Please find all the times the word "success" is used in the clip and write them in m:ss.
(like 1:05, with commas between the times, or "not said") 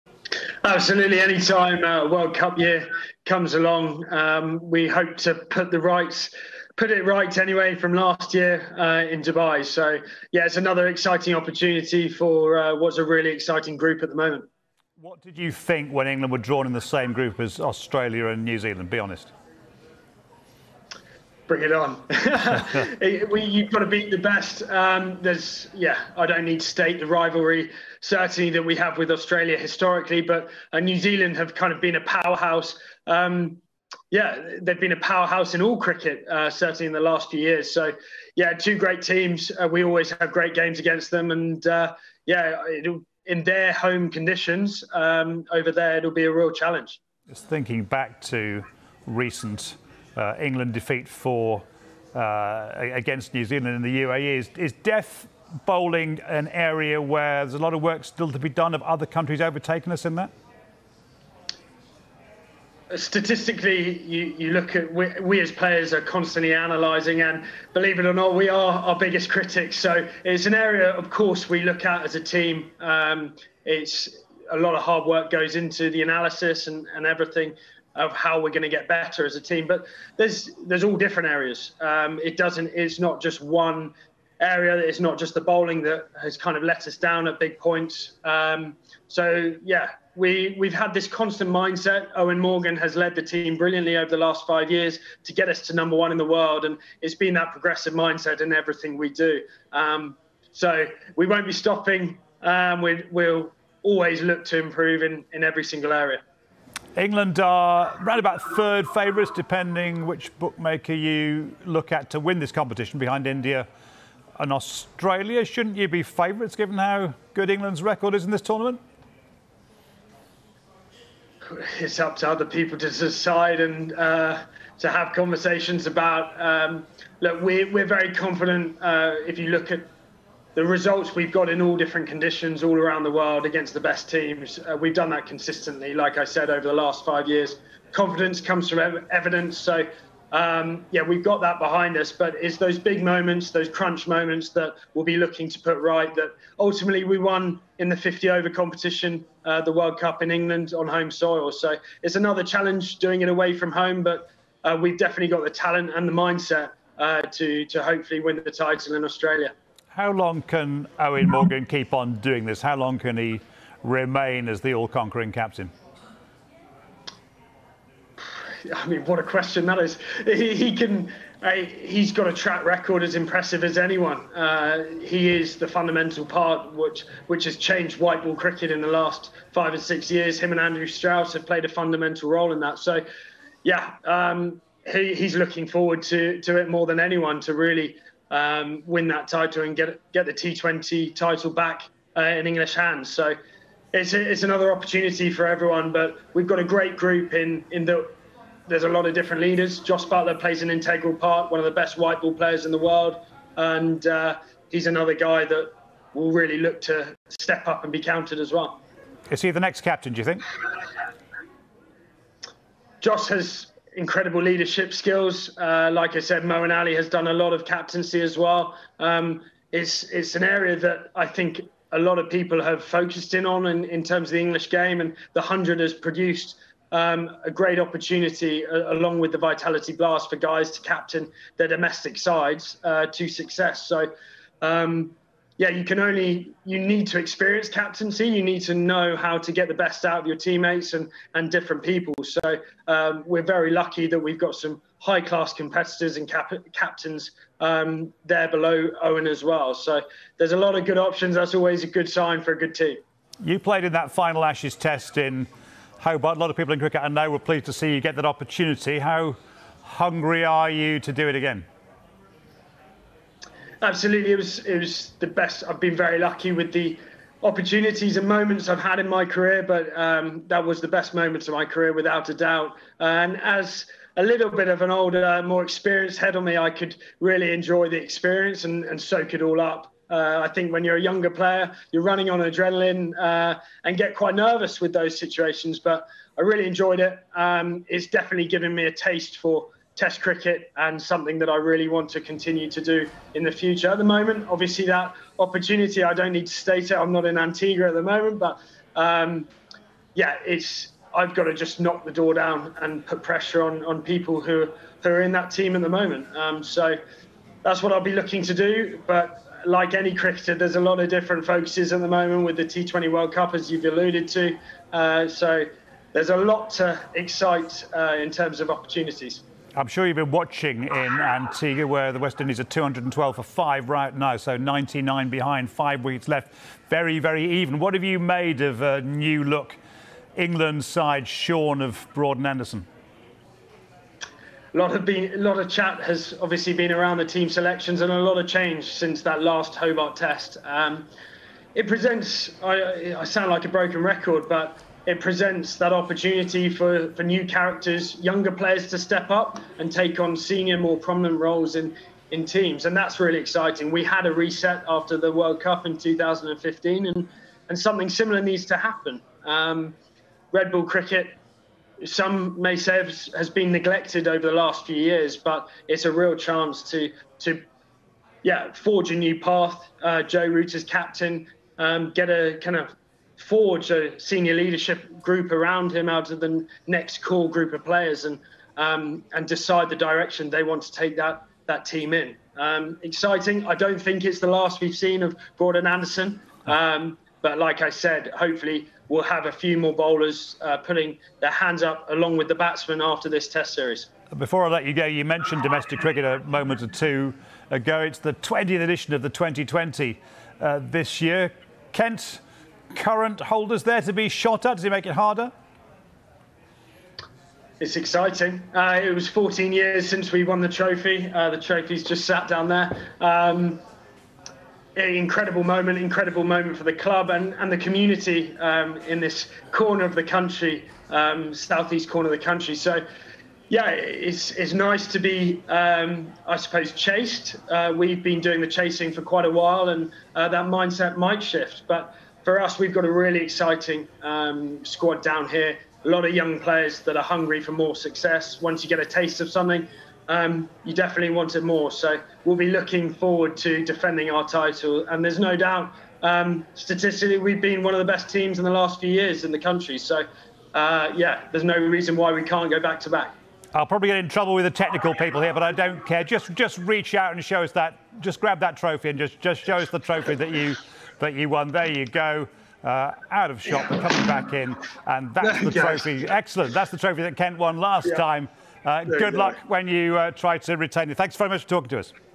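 3:53, 7:17.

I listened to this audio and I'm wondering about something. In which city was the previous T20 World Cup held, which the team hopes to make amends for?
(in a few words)
Dubai.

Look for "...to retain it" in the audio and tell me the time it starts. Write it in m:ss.
7:50.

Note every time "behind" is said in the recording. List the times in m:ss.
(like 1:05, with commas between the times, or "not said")
1:52, 2:21, 5:25.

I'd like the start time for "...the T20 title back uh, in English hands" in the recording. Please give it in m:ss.
3:10.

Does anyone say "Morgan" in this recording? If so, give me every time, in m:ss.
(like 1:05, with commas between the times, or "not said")
1:32, 2:41.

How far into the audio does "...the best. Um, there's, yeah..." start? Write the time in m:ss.
0:24.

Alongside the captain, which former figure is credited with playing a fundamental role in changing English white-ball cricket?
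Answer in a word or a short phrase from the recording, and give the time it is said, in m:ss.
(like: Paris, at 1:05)
Andrew Strauss, at 3:00.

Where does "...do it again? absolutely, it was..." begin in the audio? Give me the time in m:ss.
4:21.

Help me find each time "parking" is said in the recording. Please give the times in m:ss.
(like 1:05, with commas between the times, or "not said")
not said.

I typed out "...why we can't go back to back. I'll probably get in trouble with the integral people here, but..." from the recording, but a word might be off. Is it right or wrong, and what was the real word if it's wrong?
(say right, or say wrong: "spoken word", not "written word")
wrong: "technical", not "integral".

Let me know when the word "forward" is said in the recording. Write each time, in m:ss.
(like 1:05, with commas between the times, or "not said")
3:05, 7:23.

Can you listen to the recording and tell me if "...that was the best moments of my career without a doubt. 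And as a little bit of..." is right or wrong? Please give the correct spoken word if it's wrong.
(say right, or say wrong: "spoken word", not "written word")
right.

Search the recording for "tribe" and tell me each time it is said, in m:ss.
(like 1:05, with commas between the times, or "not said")
not said.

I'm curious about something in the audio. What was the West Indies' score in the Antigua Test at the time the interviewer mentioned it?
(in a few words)
212 for 5.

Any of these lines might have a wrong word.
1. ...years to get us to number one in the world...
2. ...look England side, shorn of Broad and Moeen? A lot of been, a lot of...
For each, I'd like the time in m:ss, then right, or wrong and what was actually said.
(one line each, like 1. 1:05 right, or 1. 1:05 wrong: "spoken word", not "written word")
1. 1:34 right
2. 5:29 wrong: "Anderson", not "Moeen".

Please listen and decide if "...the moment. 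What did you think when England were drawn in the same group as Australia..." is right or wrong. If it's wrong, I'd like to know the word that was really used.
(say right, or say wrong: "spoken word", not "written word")
right.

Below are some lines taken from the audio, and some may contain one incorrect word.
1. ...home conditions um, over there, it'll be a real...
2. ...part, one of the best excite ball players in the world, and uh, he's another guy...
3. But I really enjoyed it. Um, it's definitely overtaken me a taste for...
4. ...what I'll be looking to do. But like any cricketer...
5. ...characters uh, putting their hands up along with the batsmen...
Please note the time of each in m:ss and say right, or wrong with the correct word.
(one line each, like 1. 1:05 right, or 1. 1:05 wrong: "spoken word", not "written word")
1. 0:43 right
2. 3:21 wrong: "white", not "excite"
3. 4:45 wrong: "given", not "overtaken"
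4. 5:07 right
5. 6:29 wrong: "bowlers", not "characters".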